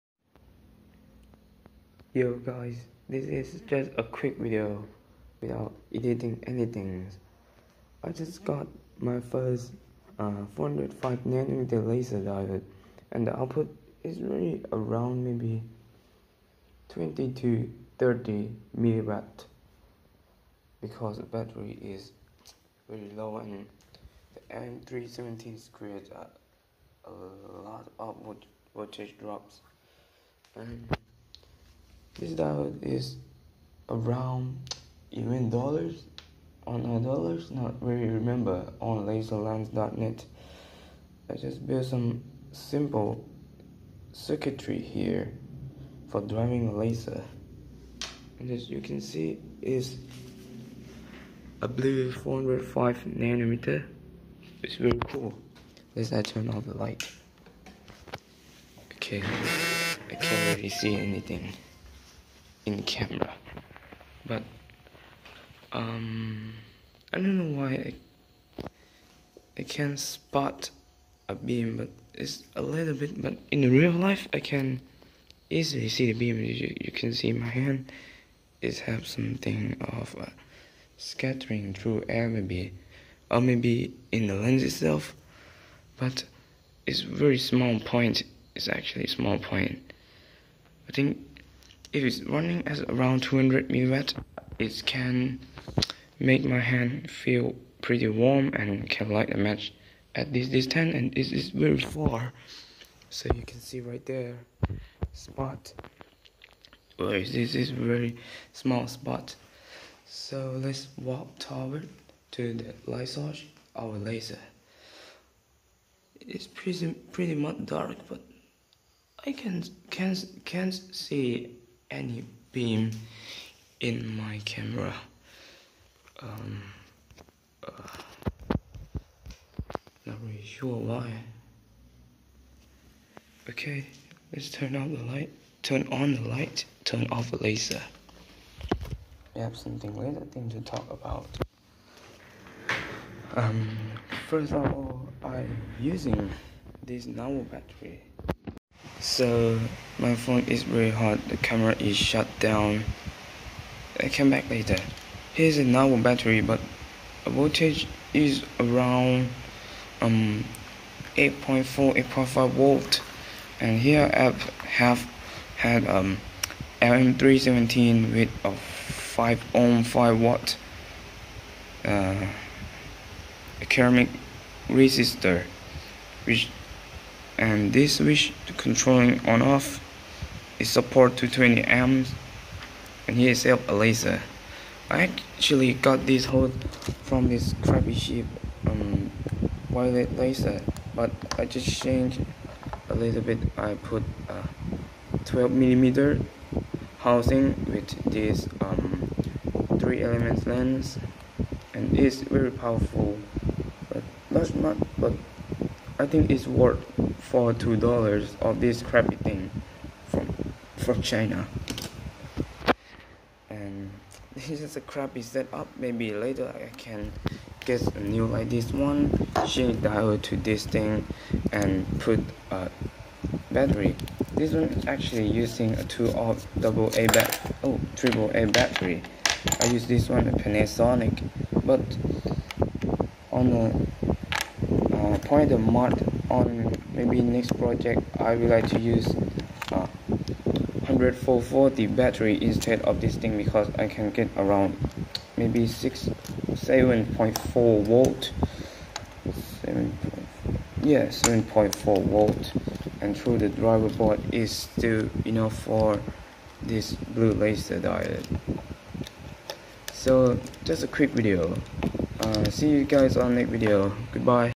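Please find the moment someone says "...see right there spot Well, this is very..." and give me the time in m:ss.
1:43.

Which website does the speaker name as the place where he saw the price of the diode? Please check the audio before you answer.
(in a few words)
laserlands.net.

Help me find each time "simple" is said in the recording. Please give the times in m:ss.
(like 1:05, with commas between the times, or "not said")
0:42.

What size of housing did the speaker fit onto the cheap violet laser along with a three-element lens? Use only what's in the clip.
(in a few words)
12 millimeter.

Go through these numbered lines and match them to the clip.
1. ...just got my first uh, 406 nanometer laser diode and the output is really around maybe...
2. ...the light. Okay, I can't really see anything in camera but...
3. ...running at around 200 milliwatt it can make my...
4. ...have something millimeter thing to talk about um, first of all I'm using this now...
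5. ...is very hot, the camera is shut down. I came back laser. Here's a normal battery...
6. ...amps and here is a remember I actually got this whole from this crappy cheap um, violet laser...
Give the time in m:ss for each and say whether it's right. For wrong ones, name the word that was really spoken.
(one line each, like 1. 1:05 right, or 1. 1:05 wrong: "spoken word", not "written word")
1. 0:08 wrong: "405", not "406"
2. 0:56 right
3. 1:32 right
4. 2:19 wrong: "later", not "millimeter"
5. 2:30 wrong: "later", not "laser"
6. 3:01 wrong: "laser", not "remember".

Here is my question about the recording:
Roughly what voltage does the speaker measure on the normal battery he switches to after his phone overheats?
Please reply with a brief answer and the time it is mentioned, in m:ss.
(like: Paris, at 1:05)
8.4 to 8.5 volts, at 2:41.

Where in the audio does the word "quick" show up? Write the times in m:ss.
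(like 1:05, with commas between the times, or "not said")
0:04, 4:20.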